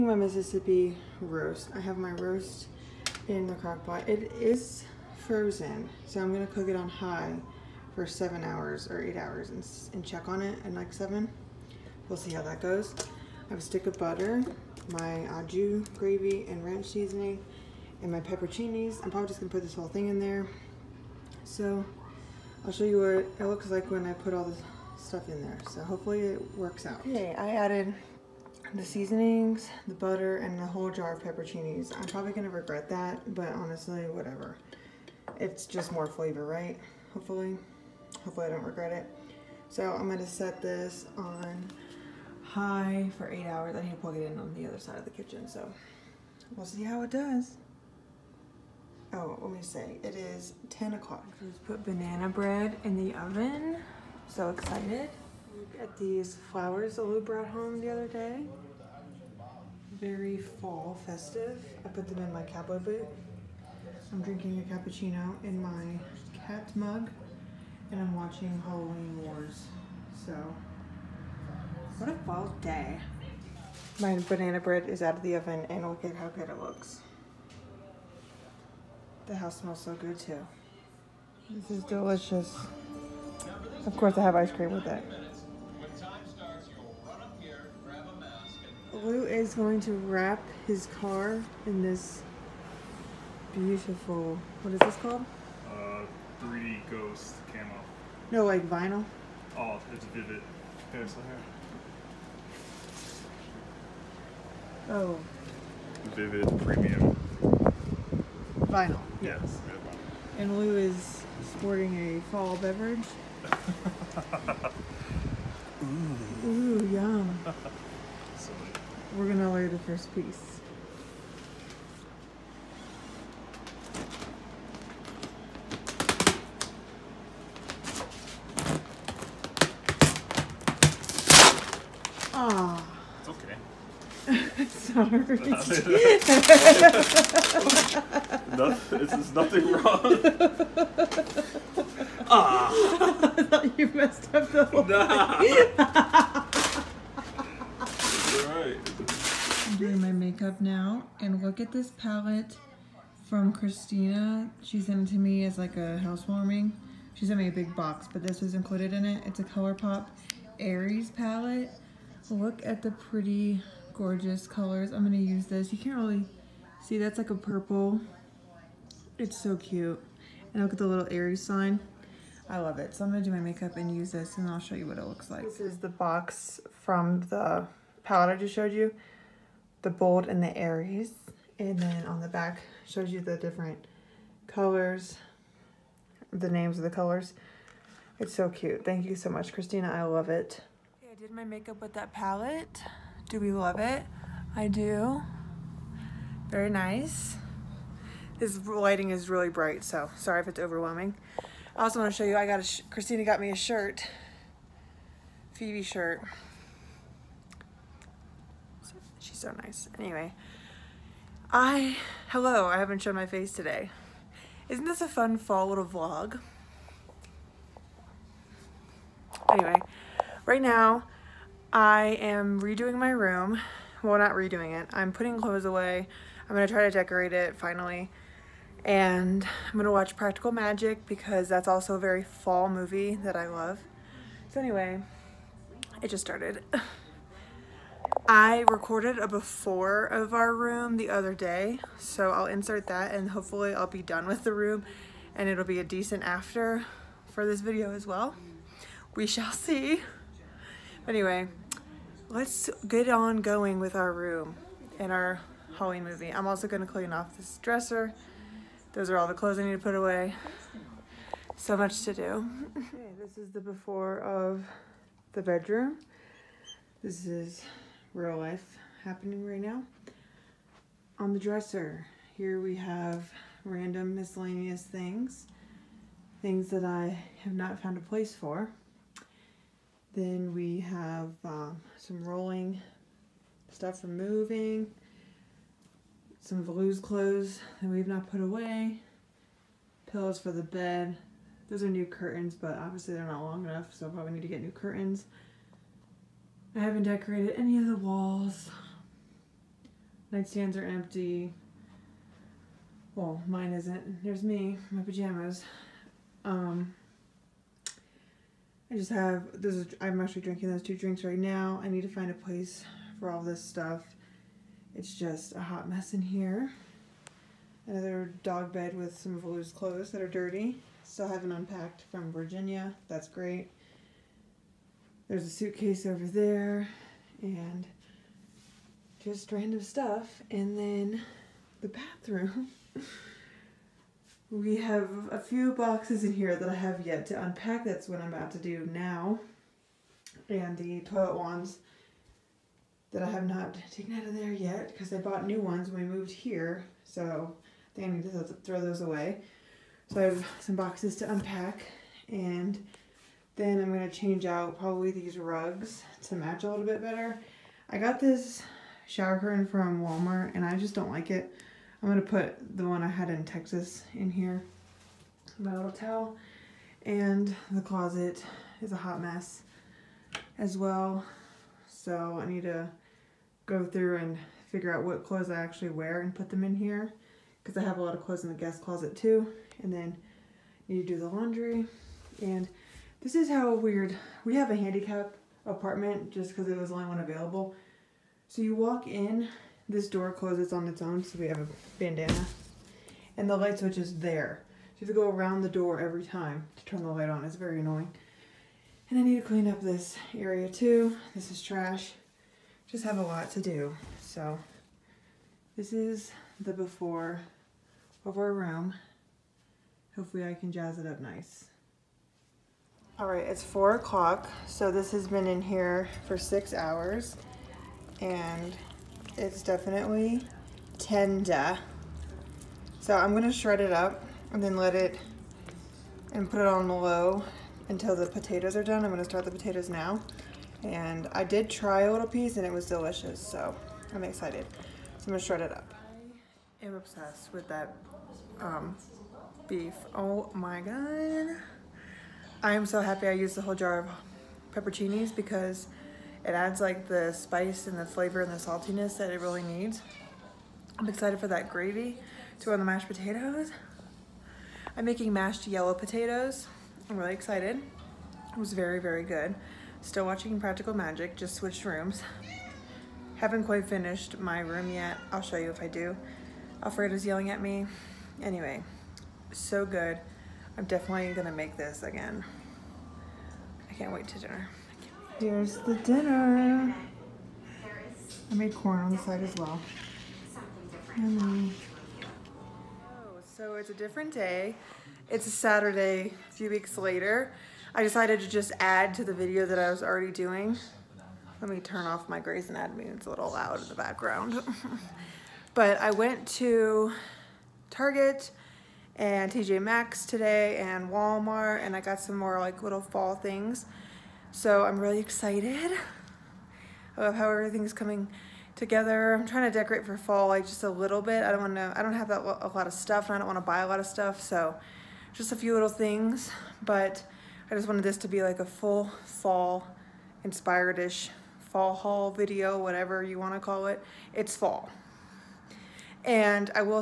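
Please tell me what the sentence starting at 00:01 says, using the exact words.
I have my roast in the crock pot.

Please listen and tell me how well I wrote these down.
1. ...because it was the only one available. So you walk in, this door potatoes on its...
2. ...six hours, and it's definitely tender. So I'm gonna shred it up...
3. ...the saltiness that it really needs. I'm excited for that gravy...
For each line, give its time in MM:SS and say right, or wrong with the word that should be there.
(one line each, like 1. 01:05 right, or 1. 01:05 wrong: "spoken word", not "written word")
1. 06:26 wrong: "closes", not "potatoes"
2. 06:56 right
3. 07:28 right.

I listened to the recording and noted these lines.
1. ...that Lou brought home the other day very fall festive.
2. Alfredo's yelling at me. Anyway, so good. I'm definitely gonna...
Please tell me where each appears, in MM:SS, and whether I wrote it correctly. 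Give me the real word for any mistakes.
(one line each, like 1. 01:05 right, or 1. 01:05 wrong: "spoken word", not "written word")
1. 00:56 right
2. 07:46 right.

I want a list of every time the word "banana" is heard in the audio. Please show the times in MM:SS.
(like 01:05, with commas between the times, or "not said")
00:51, 01:14.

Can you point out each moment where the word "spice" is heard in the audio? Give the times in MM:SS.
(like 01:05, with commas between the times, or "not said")
07:27.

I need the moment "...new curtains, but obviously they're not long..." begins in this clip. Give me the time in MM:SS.
04:51.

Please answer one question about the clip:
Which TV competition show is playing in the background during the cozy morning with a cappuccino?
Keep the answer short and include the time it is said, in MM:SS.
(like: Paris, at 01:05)
Halloween Wars, at 01:08.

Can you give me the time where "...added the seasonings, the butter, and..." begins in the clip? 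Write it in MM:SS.
00:27.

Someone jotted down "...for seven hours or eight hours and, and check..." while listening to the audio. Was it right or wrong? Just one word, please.
right.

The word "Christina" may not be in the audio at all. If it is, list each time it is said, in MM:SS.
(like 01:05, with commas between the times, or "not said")
02:33, 03:09, 03:22.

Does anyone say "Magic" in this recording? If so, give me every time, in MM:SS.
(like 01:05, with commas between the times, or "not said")
03:50, 07:40.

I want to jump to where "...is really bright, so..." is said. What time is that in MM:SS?
03:19.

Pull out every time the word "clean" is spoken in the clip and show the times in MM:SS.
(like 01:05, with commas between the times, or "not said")
04:16, 06:39.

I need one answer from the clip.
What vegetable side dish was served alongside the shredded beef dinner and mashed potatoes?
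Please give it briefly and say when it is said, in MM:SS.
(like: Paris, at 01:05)
corn, at 07:58.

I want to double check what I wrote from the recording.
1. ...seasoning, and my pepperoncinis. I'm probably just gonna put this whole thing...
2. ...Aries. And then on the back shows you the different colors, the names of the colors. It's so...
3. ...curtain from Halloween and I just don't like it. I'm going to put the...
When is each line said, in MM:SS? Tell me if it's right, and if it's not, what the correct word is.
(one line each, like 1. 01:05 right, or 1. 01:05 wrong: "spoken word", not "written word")
1. 00:16 right
2. 03:00 right
3. 05:59 wrong: "Walmart", not "Halloween".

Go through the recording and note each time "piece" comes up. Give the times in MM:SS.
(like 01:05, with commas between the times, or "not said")
02:00, 07:12.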